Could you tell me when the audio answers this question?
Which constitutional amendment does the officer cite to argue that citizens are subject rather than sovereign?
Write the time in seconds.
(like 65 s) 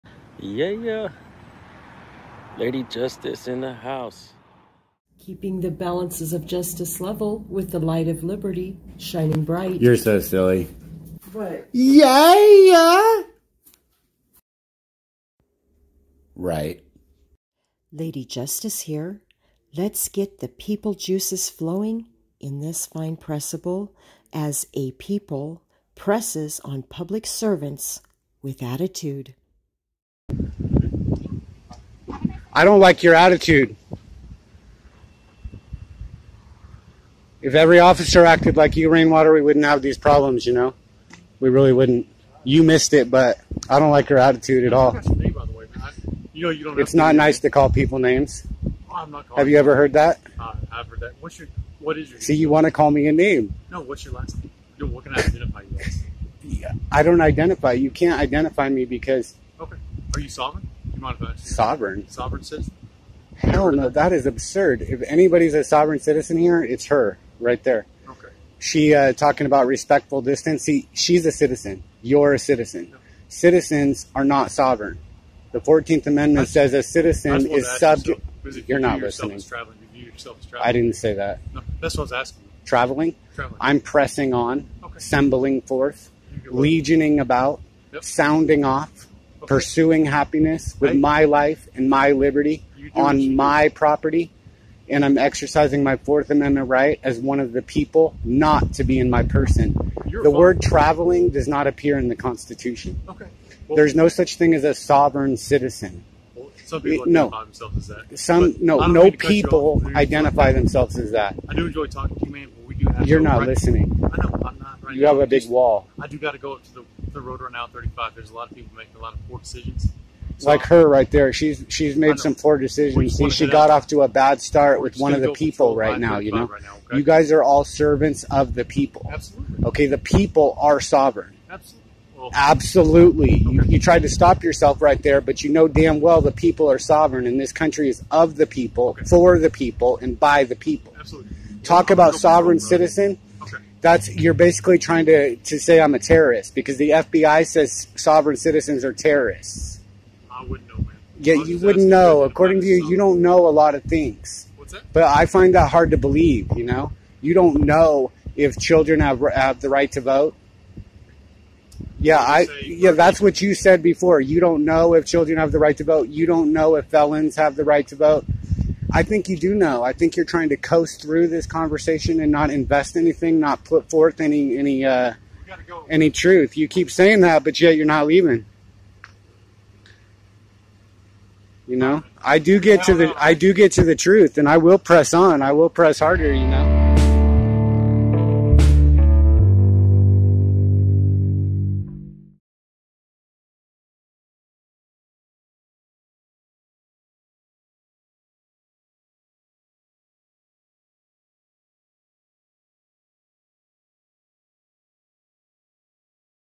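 75 s.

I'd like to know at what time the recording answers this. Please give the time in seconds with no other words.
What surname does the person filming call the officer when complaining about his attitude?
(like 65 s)
38 s.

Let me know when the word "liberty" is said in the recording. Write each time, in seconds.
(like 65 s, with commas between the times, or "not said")
8 s, 92 s.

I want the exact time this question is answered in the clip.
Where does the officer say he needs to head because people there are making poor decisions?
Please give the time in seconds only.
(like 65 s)
117 s.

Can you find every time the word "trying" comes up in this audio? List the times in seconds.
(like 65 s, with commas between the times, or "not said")
144 s, 170 s.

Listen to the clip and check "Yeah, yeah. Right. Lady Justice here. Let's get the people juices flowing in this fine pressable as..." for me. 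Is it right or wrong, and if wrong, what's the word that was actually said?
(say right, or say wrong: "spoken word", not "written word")
right.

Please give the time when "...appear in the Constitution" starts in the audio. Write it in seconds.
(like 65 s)
101 s.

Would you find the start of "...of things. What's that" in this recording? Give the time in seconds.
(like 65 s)
153 s.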